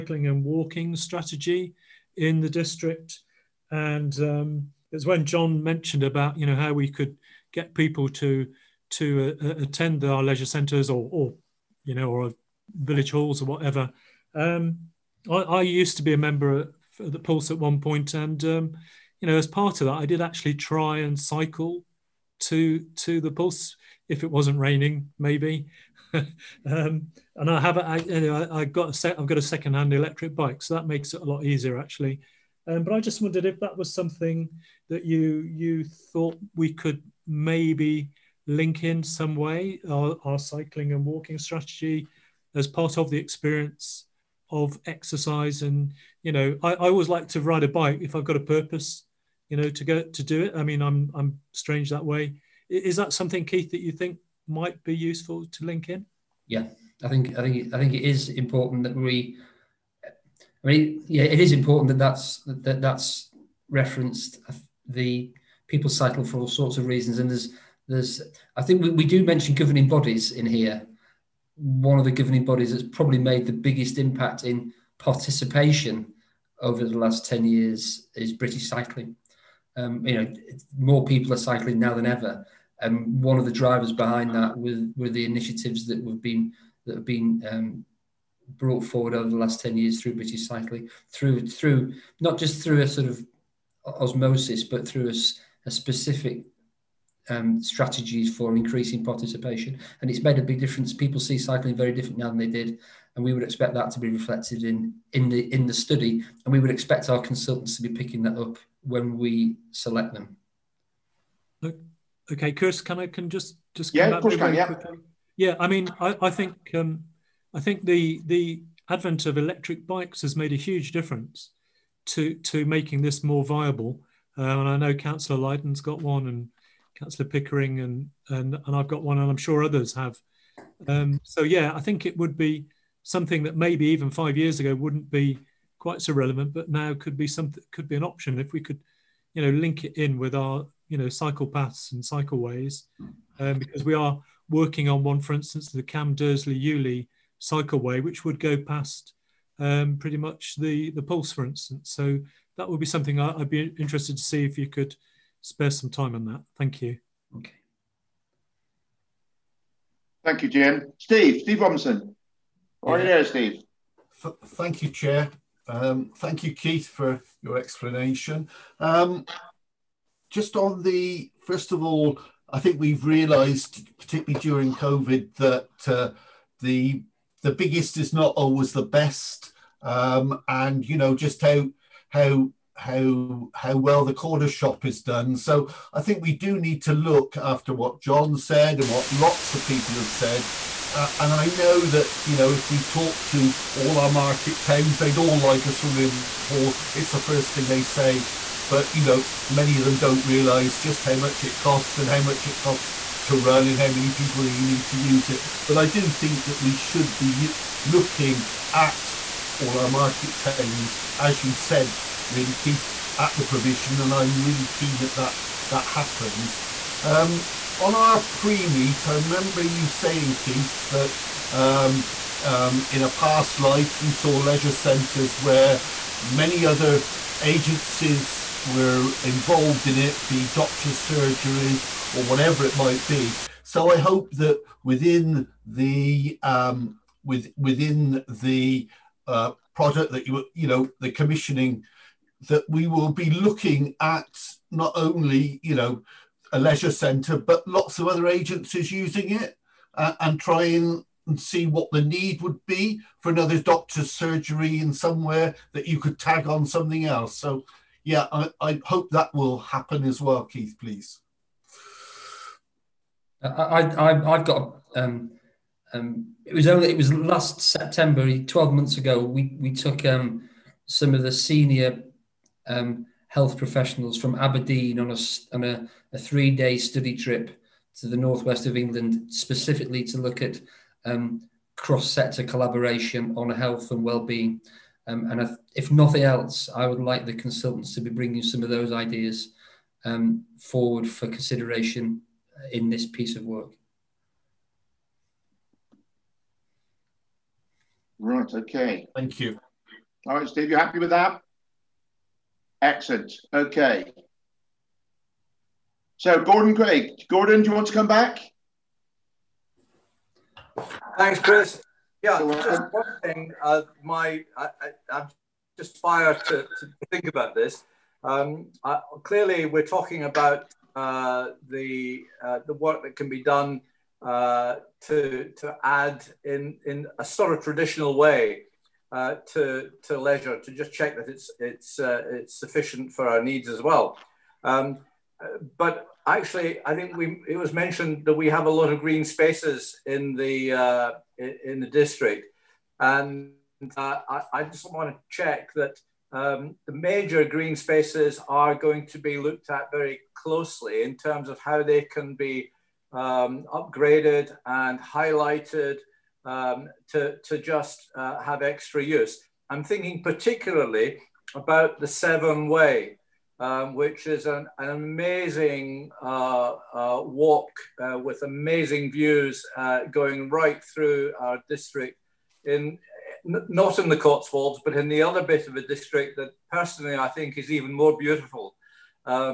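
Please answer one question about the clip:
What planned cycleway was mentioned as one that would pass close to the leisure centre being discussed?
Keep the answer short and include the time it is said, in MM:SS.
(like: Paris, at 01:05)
Cam Dursley Uley cycleway, at 02:25.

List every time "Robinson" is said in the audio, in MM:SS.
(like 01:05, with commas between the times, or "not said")
02:41.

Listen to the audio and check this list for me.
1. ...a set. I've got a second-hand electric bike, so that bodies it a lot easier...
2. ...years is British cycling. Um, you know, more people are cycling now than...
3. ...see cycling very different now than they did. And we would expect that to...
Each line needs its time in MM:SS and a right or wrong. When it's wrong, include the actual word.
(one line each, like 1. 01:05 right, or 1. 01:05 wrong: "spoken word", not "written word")
1. 00:28 wrong: "makes", not "bodies"
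2. 01:17 right
3. 01:41 right.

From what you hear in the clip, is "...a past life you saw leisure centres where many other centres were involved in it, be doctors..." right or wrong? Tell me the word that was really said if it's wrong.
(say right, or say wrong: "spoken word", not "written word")
wrong: "agencies", not "centres".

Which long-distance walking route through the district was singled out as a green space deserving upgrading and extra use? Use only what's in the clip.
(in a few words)
Severn Way.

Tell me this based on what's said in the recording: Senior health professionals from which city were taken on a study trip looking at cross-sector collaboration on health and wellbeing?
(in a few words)
Aberdeen.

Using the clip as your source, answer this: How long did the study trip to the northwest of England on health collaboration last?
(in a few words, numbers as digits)
3 days.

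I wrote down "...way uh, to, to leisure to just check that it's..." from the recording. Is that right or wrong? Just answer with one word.
right.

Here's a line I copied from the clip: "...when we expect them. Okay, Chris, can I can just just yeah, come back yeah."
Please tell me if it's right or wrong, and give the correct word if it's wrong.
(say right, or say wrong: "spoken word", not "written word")
wrong: "select", not "expect".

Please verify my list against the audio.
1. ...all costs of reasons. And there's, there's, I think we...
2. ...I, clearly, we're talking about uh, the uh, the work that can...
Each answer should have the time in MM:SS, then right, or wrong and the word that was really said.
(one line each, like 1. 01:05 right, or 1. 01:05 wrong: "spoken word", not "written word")
1. 01:06 wrong: "sorts", not "costs"
2. 05:18 right.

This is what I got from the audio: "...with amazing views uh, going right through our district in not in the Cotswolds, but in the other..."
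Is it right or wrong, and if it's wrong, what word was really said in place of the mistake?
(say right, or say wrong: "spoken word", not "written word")
right.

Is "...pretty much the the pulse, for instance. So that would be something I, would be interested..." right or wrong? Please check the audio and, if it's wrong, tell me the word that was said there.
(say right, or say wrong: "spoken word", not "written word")
right.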